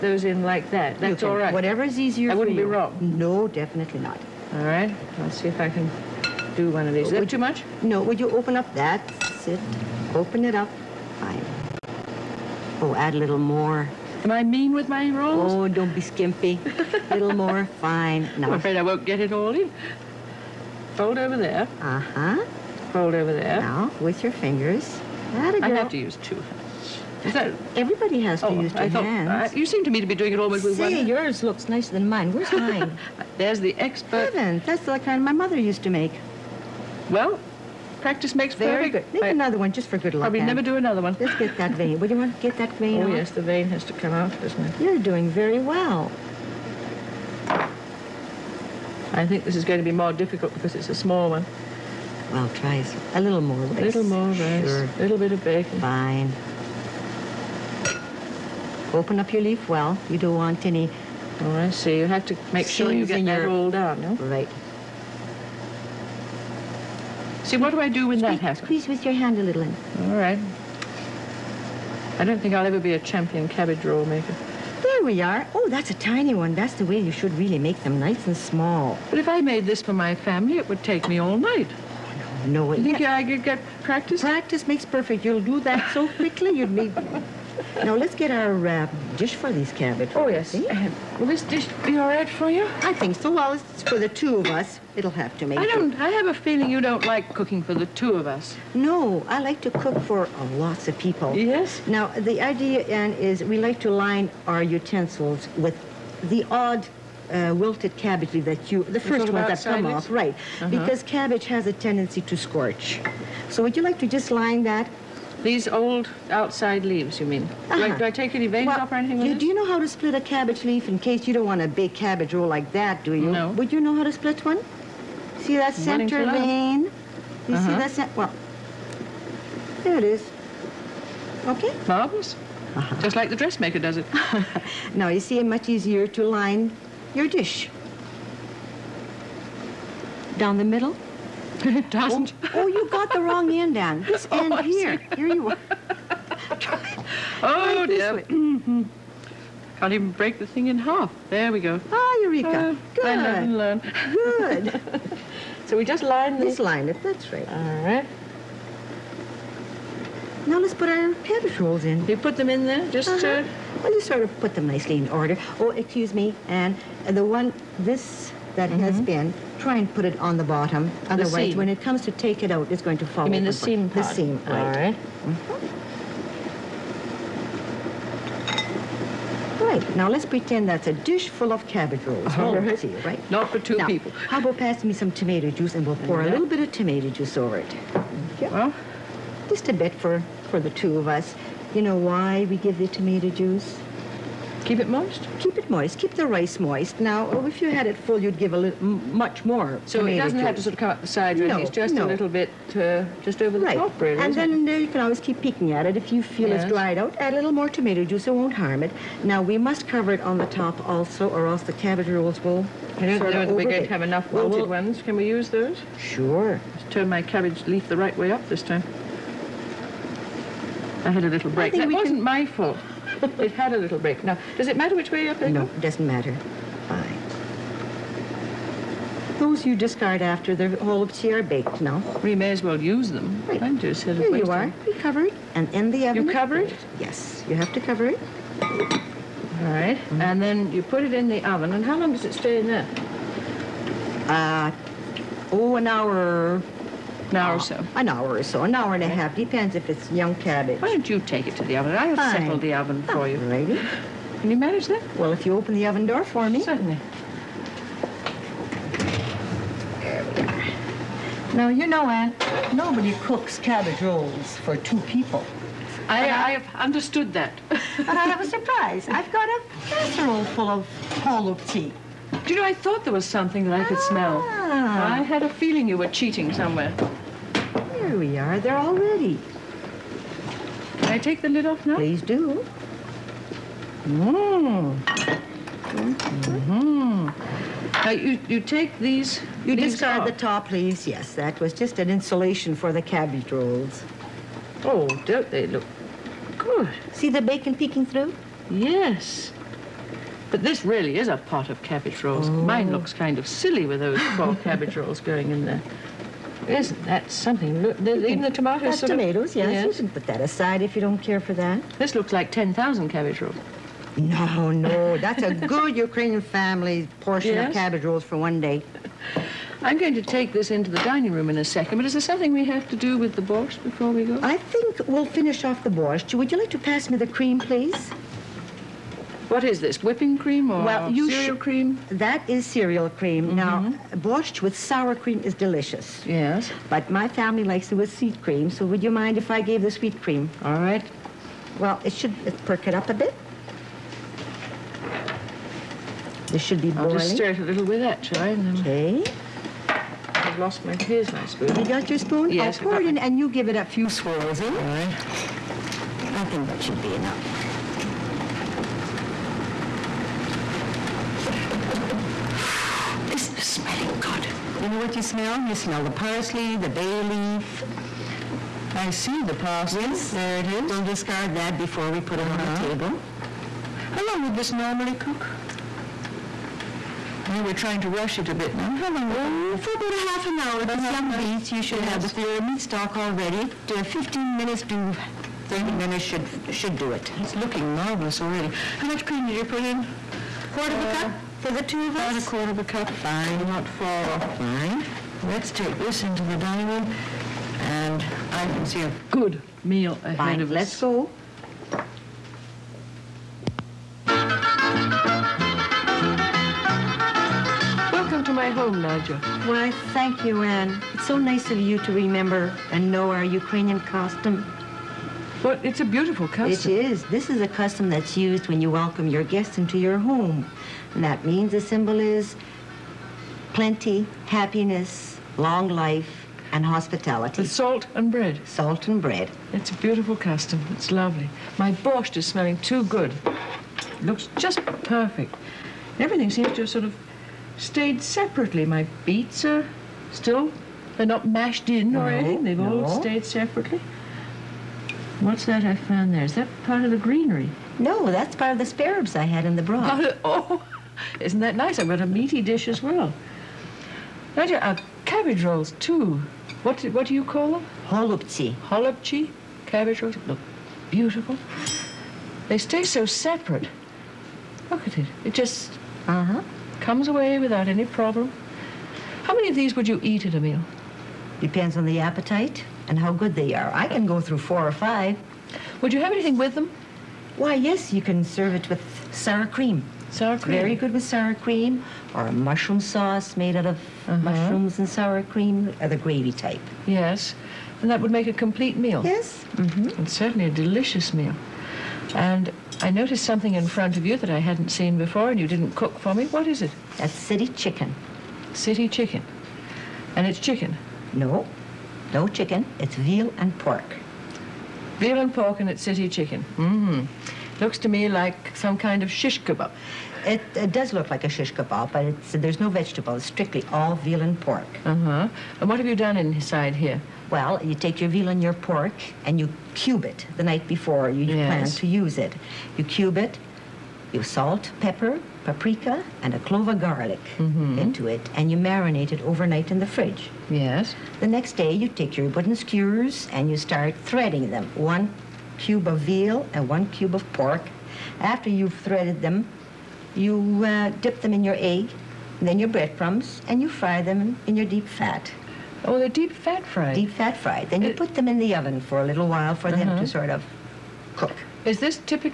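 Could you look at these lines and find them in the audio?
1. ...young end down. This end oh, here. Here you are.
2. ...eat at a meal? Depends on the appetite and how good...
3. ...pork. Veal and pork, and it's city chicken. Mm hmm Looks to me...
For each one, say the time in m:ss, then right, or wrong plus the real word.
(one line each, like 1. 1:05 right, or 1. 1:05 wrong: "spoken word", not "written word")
1. 2:23 wrong: "wrong", not "young"
2. 7:50 right
3. 8:23 right.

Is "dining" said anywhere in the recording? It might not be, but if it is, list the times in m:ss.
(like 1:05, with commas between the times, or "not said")
5:20, 6:36.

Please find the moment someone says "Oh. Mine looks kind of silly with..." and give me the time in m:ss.
5:02.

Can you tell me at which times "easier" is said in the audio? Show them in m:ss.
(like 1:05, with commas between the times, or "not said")
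0:01, 2:15.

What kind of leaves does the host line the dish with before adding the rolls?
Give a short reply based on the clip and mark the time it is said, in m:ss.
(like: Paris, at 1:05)
wilted cabbage leaf, at 1:47.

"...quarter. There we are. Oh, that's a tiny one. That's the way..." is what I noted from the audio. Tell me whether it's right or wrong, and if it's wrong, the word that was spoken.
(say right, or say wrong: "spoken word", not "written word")
wrong: "maker", not "quarter".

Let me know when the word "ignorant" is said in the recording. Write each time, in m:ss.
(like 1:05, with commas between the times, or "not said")
not said.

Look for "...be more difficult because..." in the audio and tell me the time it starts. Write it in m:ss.
0:49.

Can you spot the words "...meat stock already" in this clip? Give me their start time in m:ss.
6:22.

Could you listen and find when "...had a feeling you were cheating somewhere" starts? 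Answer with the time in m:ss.
4:35.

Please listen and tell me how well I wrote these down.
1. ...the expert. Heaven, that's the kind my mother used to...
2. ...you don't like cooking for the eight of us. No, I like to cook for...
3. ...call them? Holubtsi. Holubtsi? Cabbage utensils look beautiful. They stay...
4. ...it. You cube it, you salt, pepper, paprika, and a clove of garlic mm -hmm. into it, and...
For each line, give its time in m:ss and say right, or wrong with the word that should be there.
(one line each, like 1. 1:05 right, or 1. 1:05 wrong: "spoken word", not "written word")
1. 0:33 right
2. 1:36 wrong: "two", not "eight"
3. 7:37 wrong: "rolls", not "utensils"
4. 8:42 right.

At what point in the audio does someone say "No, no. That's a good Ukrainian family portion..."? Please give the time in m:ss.
5:14.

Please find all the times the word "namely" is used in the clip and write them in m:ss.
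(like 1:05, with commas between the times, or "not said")
not said.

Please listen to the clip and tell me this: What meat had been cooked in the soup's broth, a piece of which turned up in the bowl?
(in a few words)
spare ribs.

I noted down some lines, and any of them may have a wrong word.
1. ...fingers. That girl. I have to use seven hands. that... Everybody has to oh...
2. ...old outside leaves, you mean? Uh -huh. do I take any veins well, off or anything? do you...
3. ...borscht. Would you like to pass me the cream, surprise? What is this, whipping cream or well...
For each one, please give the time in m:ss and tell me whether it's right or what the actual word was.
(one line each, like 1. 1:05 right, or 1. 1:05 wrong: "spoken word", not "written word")
1. 0:24 wrong: "two", not "seven"
2. 1:55 right
3. 5:25 wrong: "please", not "surprise".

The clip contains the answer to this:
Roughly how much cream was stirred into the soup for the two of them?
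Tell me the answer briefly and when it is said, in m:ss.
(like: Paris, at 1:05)
a quarter of a cup, at 6:32.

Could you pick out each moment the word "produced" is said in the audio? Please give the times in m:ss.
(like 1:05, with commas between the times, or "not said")
not said.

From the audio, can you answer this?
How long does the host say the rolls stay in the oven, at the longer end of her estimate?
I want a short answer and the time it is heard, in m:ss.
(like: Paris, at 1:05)
an hour and a half, at 4:08.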